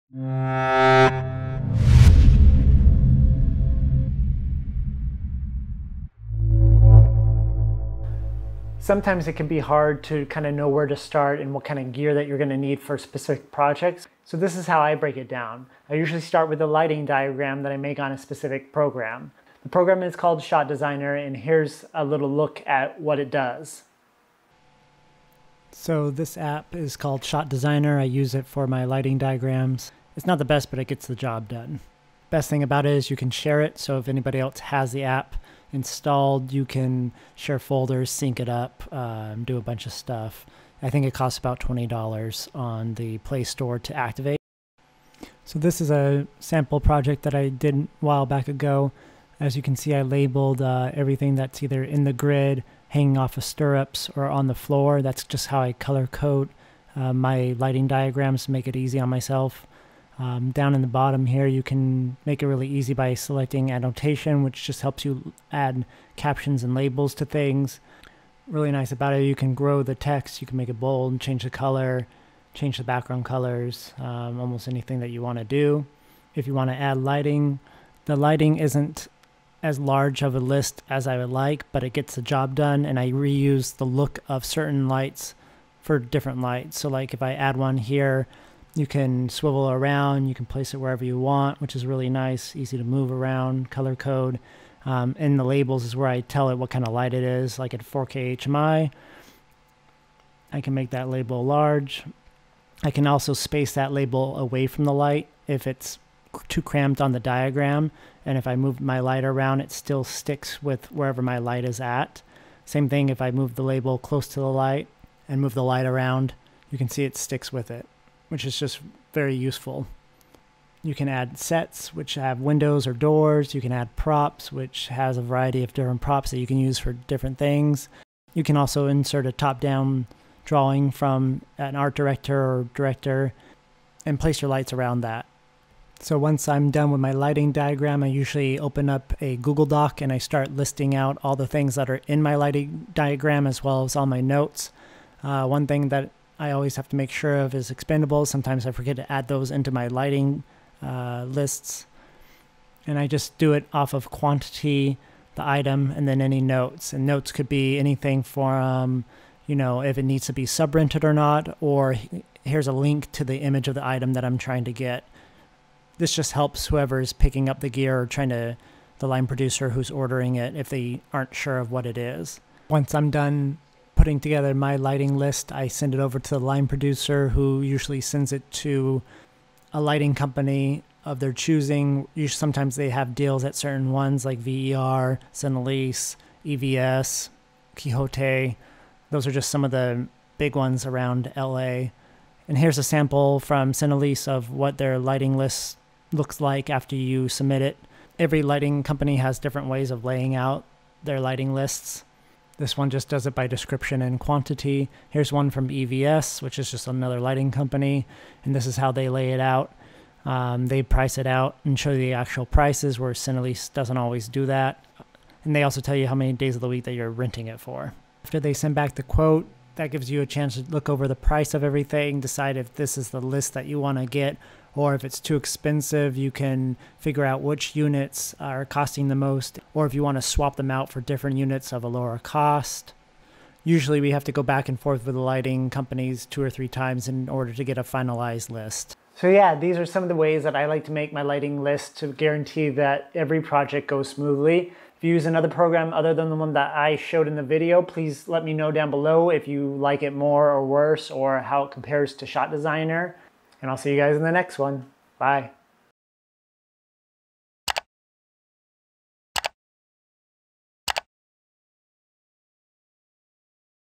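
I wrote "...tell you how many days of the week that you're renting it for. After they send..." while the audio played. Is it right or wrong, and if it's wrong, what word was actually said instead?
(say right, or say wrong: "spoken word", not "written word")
right.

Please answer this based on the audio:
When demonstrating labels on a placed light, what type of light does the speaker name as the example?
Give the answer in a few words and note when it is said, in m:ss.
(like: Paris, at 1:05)
4K HMI, at 1:37.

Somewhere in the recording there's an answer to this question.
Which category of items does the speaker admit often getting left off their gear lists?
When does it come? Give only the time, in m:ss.
2:27.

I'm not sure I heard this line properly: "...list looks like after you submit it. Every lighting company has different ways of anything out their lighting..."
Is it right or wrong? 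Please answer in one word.
wrong.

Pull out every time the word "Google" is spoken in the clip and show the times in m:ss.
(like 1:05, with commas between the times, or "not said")
2:19.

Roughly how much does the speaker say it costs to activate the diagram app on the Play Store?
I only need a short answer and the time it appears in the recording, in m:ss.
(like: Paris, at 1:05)
$20, at 0:41.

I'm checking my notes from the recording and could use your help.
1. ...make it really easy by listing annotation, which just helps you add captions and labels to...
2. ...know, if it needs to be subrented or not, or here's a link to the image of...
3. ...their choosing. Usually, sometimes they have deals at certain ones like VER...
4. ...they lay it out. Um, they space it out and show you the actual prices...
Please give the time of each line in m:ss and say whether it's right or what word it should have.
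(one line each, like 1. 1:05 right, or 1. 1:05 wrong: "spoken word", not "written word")
1. 1:02 wrong: "selecting", not "listing"
2. 2:39 right
3. 3:01 right
4. 3:28 wrong: "price", not "space".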